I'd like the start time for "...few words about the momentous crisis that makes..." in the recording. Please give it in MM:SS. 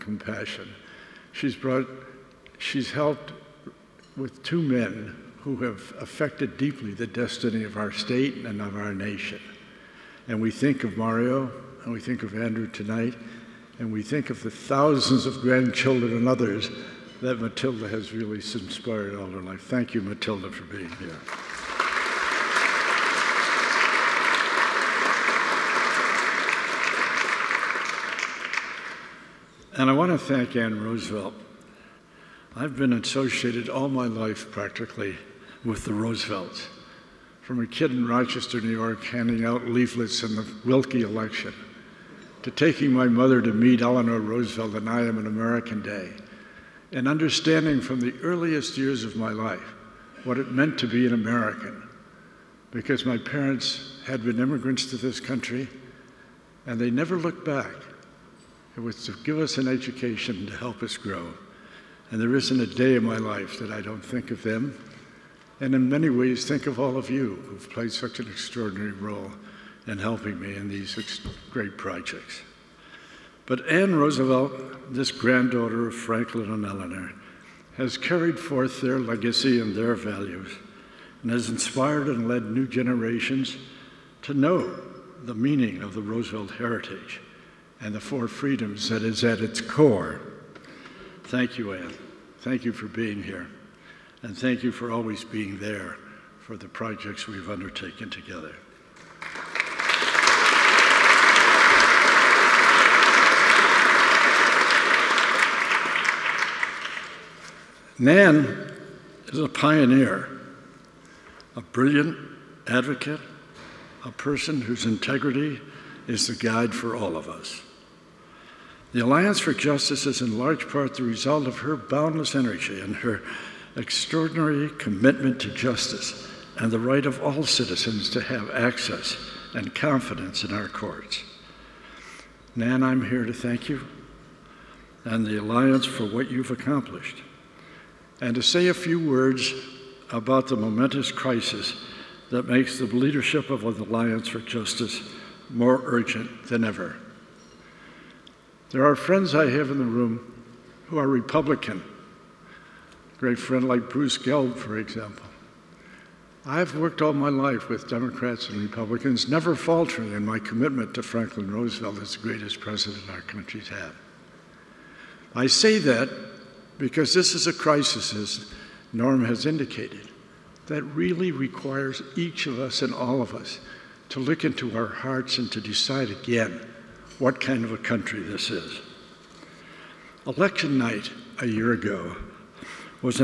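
02:18.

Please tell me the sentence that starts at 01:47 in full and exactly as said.
Nan is a pioneer, a brilliant advocate, a person whose integrity is the guide for all of us.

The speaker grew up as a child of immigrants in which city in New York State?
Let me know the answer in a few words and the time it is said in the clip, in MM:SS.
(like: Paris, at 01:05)
Rochester, at 00:38.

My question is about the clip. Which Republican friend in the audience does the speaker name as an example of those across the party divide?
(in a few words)
Bruce Gelb.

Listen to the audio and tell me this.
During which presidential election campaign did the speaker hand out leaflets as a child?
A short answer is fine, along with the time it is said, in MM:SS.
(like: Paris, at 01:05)
Willkie election, at 00:40.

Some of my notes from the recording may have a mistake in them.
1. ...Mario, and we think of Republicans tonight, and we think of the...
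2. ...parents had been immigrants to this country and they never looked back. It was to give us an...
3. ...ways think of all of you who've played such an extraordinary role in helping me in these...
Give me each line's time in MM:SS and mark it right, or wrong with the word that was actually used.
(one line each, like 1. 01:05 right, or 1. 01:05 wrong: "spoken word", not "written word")
1. 00:10 wrong: "Andrew", not "Republicans"
2. 00:53 right
3. 01:06 right.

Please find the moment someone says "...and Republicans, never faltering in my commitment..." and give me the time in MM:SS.
02:38.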